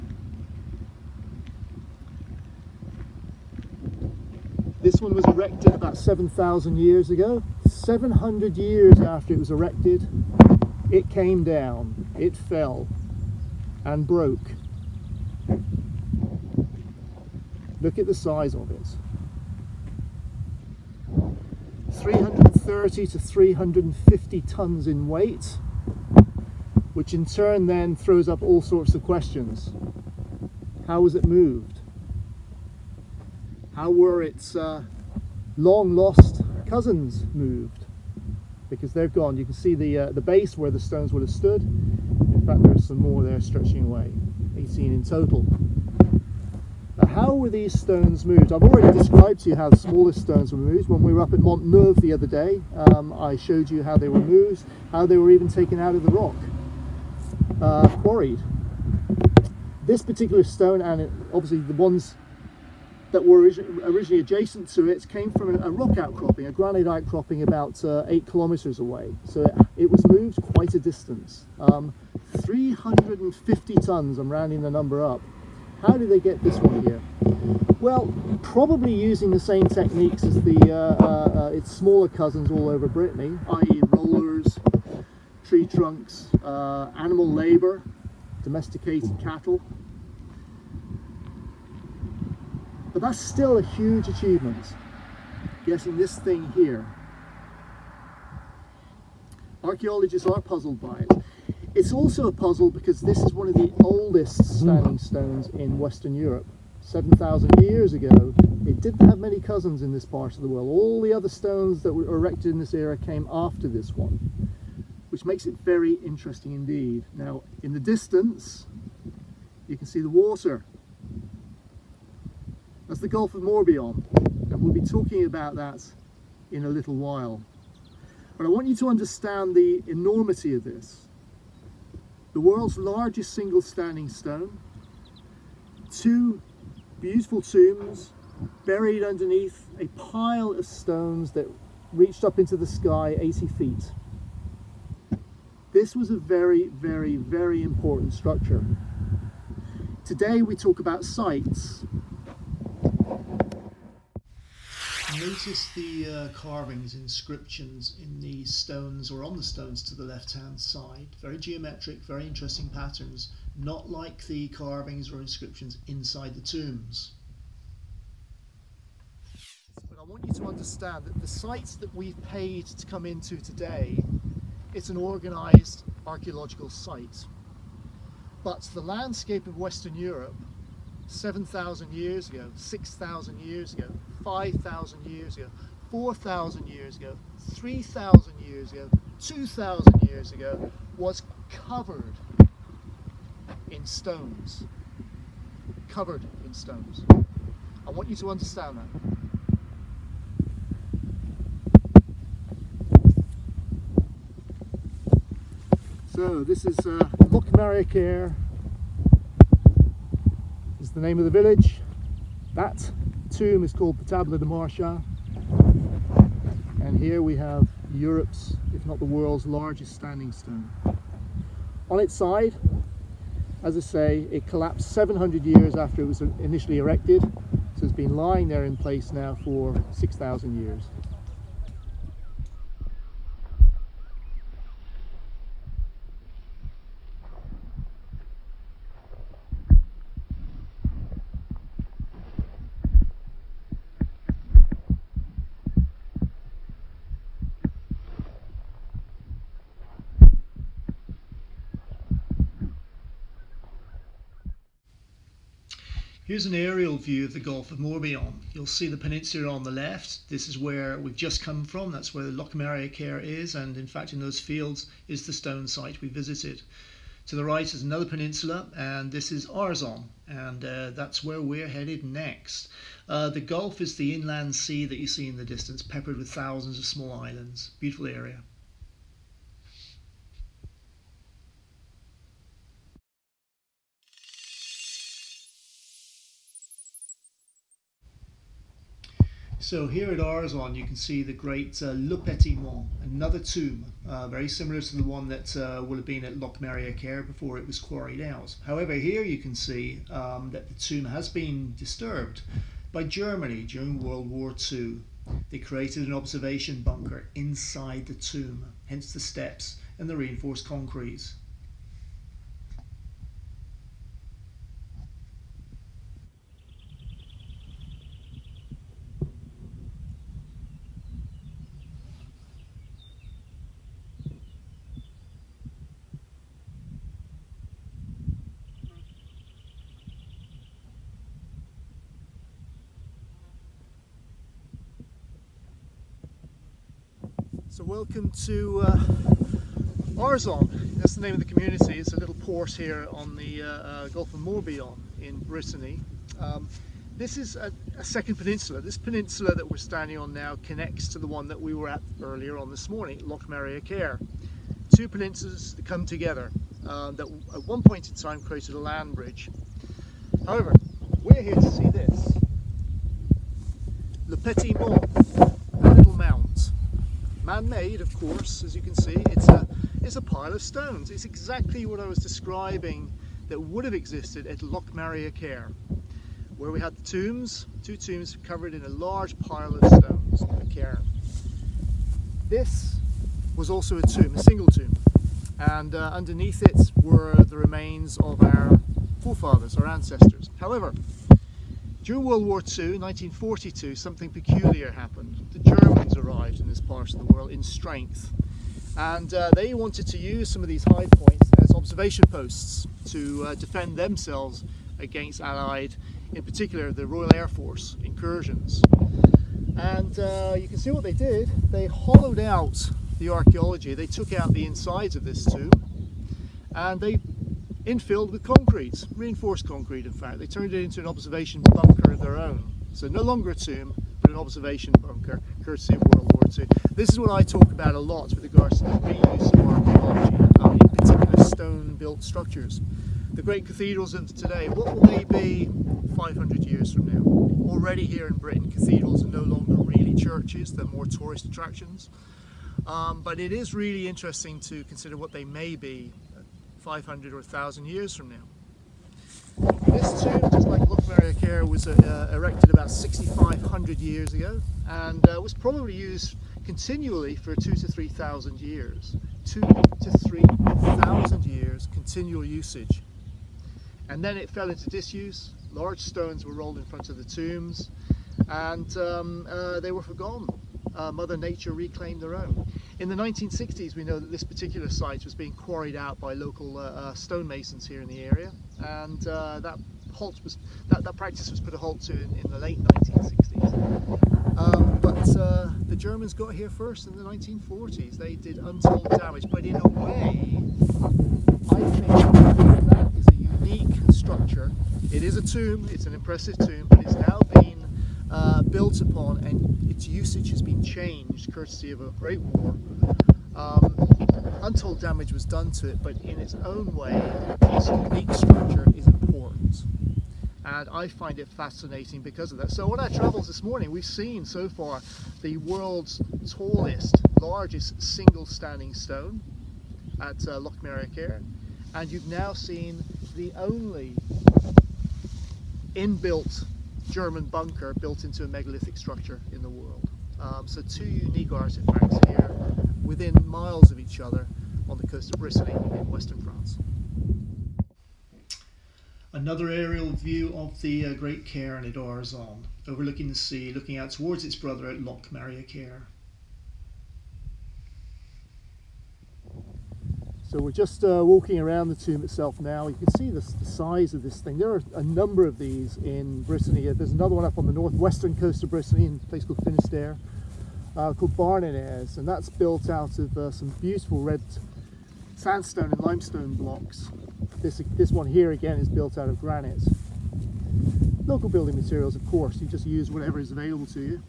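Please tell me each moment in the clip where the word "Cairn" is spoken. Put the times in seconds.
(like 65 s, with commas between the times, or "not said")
541 s, 545 s.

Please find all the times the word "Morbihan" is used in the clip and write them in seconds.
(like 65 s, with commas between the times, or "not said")
123 s, 257 s, 344 s.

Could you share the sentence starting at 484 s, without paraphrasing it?
Um, but uh, the Germans got here first in the 1940s.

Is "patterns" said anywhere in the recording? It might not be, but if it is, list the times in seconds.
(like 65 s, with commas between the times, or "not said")
162 s.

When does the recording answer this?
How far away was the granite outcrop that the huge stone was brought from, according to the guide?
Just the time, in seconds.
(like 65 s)
68 s.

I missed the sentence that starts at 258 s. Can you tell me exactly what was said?
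You'll see the peninsula on the left.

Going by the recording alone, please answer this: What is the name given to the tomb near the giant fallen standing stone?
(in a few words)
Table de Marchand.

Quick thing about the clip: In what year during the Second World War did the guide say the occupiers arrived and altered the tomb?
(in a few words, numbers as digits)
1942.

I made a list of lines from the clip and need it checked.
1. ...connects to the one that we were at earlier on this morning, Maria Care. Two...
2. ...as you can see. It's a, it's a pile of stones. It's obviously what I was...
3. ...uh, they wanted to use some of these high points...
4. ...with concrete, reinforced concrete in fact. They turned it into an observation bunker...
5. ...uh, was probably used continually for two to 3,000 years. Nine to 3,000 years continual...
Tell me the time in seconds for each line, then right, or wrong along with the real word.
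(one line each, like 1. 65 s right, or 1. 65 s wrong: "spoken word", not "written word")
1. 350 s right
2. 368 s wrong: "exactly", not "obviously"
3. 399 s right
4. 418 s right
5. 455 s wrong: "Two", not "Nine".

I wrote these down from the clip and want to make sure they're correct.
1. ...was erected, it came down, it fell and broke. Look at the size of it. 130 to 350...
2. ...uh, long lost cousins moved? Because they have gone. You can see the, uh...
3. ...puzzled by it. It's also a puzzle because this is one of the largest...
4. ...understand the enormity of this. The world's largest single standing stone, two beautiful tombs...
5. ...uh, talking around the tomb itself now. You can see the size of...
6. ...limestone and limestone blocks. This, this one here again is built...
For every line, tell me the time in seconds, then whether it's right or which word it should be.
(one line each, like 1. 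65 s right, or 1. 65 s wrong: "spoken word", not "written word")
1. 9 s wrong: "330", not "130"
2. 34 s right
3. 100 s wrong: "oldest", not "largest"
4. 128 s right
5. 551 s wrong: "walking", not "talking"
6. 565 s wrong: "sandstone", not "limestone".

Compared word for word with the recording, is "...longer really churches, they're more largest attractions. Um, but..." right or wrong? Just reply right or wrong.
wrong.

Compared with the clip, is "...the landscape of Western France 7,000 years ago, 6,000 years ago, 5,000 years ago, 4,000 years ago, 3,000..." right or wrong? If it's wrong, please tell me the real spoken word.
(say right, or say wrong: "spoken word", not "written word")
wrong: "Europe", not "France".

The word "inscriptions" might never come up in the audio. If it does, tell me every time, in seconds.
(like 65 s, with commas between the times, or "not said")
156 s, 165 s.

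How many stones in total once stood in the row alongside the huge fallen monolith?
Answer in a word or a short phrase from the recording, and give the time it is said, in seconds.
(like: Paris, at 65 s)
18, at 44 s.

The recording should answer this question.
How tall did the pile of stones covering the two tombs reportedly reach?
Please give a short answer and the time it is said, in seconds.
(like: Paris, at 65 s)
80 feet, at 143 s.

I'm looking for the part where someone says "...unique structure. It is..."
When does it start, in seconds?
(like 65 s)
493 s.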